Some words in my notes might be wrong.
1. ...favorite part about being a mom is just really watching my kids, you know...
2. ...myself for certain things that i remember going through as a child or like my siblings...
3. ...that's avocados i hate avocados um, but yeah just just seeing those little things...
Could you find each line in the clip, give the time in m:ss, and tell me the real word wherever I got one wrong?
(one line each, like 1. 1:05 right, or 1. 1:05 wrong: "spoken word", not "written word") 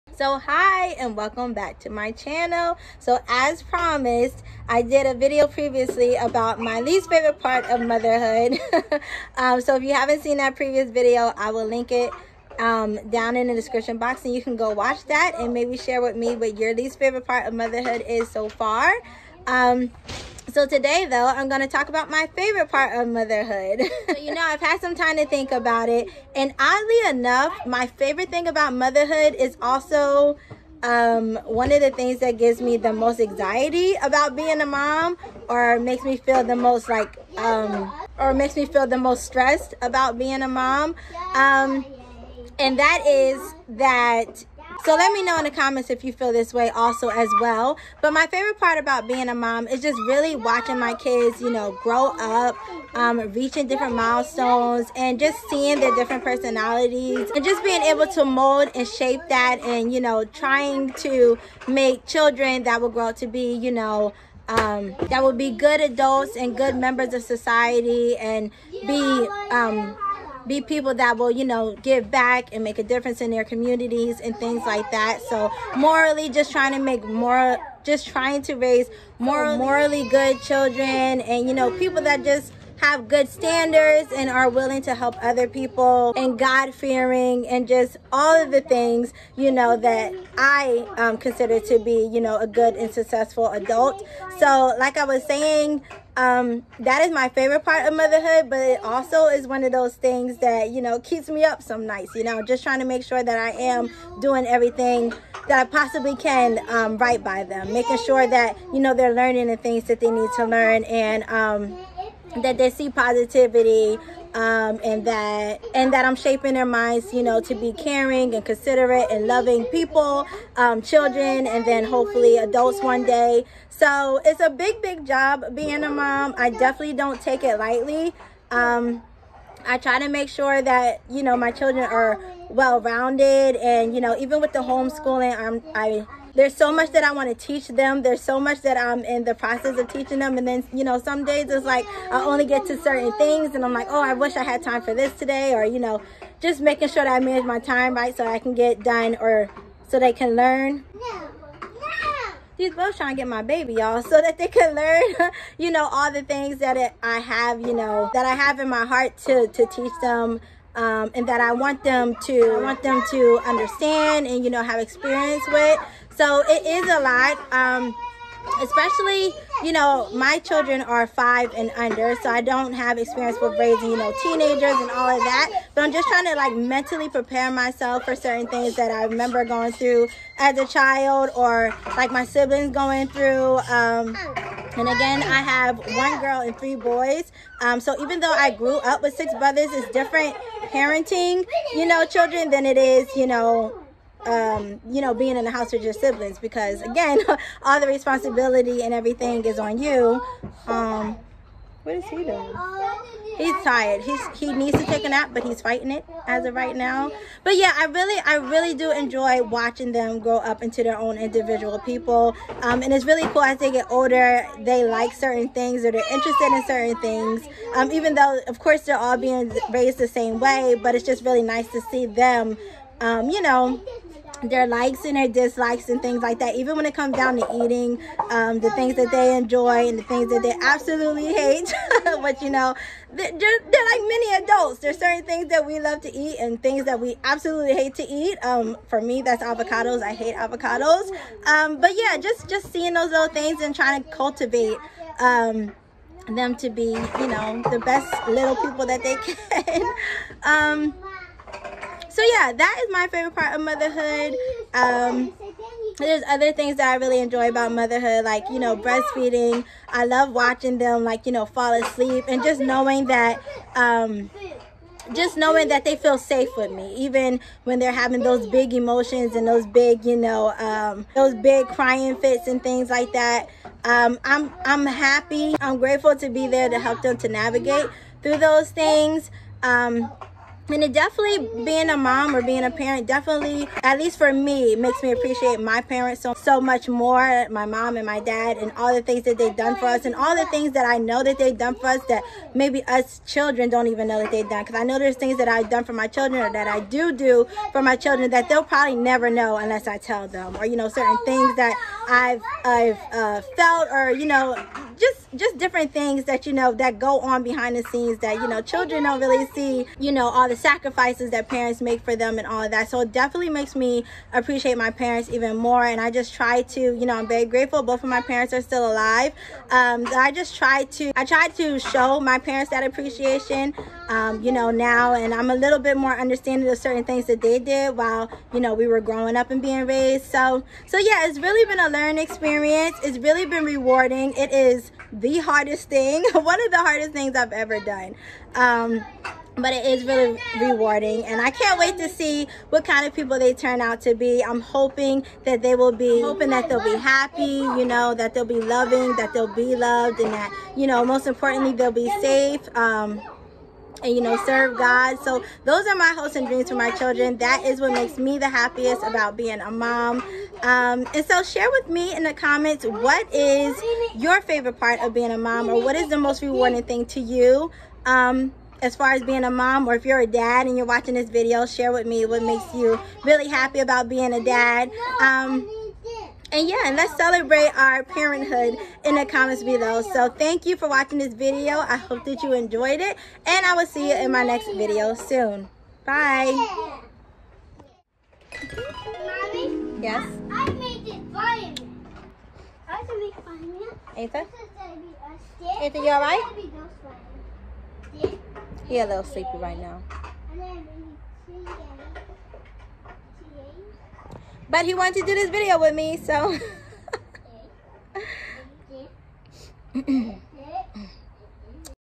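1. 0:48 right
2. 2:57 right
3. 3:59 right.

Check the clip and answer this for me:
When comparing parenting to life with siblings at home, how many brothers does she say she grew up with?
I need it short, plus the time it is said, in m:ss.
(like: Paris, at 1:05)
6, at 3:09.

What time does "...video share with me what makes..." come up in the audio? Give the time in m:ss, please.
6:11.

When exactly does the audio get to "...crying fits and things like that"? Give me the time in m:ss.
4:31.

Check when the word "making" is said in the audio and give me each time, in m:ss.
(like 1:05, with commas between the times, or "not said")
1:47, 2:26.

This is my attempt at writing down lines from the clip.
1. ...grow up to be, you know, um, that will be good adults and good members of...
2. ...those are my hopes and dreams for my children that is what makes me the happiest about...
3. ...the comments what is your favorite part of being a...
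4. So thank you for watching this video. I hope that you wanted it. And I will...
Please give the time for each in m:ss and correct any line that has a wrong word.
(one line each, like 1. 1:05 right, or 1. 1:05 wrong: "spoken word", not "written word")
1. 1:02 right
2. 5:55 right
3. 6:02 right
4. 6:20 wrong: "enjoyed", not "wanted".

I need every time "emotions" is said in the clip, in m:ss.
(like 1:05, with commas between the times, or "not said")
4:28.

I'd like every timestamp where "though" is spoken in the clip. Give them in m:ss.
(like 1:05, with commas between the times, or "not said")
0:21, 3:08, 3:38.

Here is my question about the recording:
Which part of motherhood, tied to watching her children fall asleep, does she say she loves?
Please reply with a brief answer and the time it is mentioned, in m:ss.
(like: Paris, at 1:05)
Breastfeeding, at 4:18.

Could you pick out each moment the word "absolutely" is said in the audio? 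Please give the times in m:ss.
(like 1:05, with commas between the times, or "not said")
3:50, 3:57.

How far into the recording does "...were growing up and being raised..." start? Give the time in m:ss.
5:28.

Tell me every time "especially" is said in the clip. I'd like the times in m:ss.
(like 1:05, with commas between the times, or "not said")
2:48.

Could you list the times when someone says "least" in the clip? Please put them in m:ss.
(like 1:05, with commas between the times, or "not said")
0:06, 0:16, 4:43.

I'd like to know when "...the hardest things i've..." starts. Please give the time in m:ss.
5:36.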